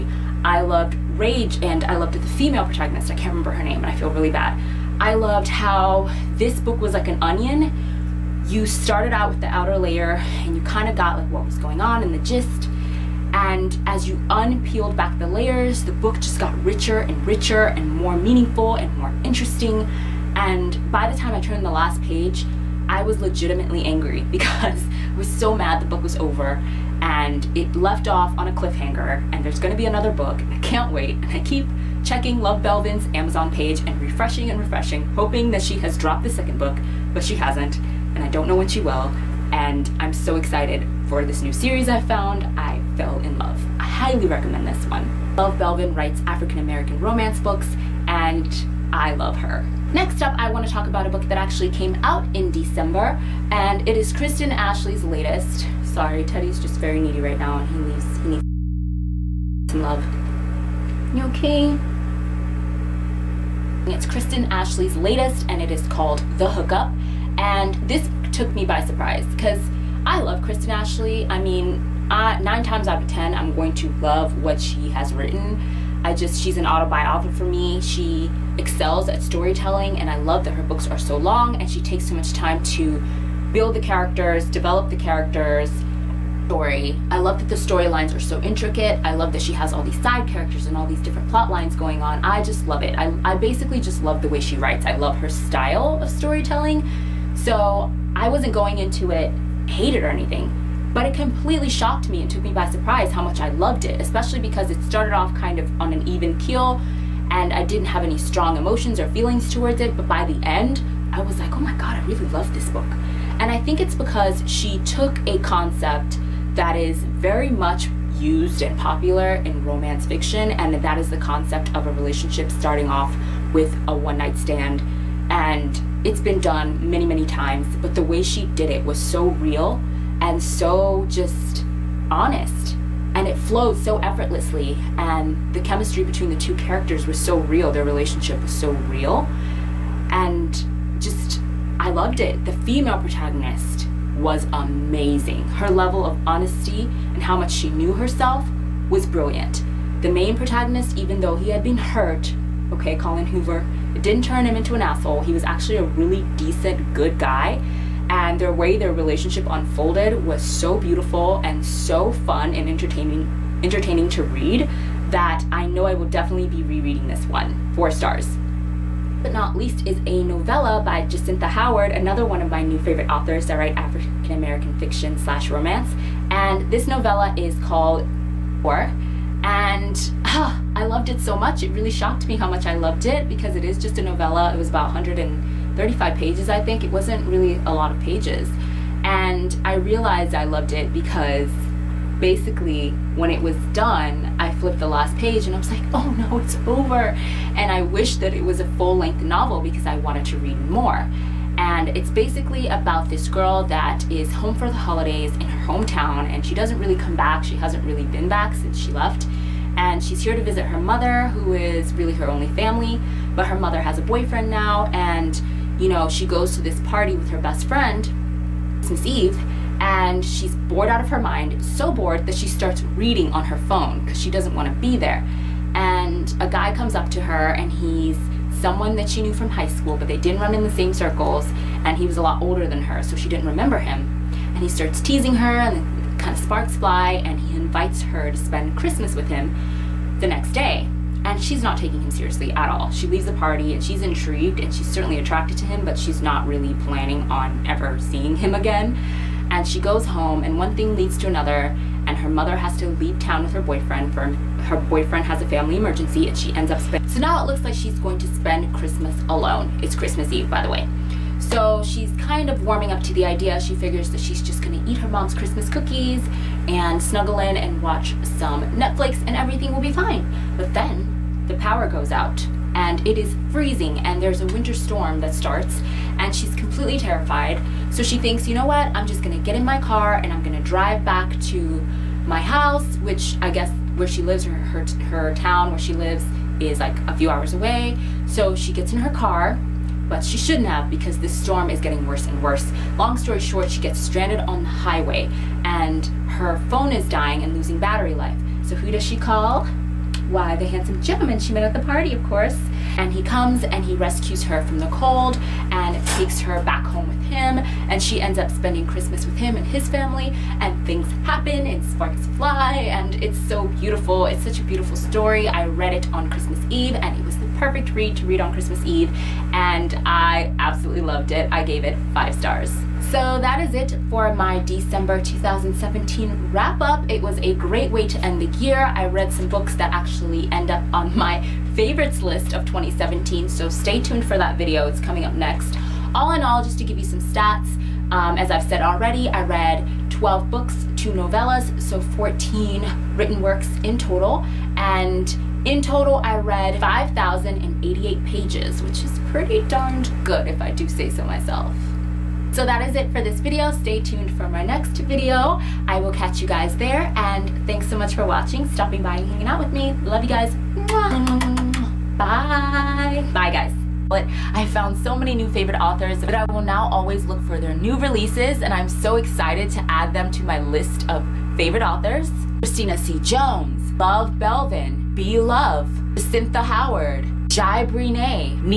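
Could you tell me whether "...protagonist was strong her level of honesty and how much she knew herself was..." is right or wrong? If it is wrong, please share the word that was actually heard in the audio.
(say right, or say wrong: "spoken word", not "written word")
wrong: "amazing", not "strong".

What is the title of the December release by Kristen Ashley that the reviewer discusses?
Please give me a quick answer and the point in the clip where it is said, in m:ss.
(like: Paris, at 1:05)
The Hookup, at 1:06.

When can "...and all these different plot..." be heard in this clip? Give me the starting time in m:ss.
1:30.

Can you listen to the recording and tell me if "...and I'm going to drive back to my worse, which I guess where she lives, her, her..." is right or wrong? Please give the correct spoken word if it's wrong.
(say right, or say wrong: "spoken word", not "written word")
wrong: "house", not "worse".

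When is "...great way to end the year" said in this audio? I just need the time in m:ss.
5:27.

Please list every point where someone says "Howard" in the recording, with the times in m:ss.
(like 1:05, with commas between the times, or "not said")
2:51, 6:16.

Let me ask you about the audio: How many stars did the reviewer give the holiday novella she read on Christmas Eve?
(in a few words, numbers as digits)
5.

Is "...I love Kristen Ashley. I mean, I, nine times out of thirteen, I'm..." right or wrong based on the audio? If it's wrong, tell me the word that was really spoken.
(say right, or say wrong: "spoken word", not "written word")
wrong: "ten", not "thirteen".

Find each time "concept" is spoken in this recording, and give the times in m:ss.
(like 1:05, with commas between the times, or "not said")
1:55, 2:01.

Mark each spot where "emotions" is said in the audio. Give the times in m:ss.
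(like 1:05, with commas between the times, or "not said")
1:48.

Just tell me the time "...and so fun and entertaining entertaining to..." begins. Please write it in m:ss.
2:41.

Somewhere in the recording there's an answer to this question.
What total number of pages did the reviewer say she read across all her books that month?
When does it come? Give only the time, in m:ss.
5:46.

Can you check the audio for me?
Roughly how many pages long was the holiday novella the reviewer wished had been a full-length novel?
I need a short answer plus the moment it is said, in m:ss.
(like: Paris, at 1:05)
135, at 3:04.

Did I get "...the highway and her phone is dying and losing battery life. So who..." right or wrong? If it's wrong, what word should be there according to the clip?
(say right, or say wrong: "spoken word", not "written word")
right.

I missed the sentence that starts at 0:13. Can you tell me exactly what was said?
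And as you unpeeled back the layers, the book just got richer and richer and more meaningful and more interesting.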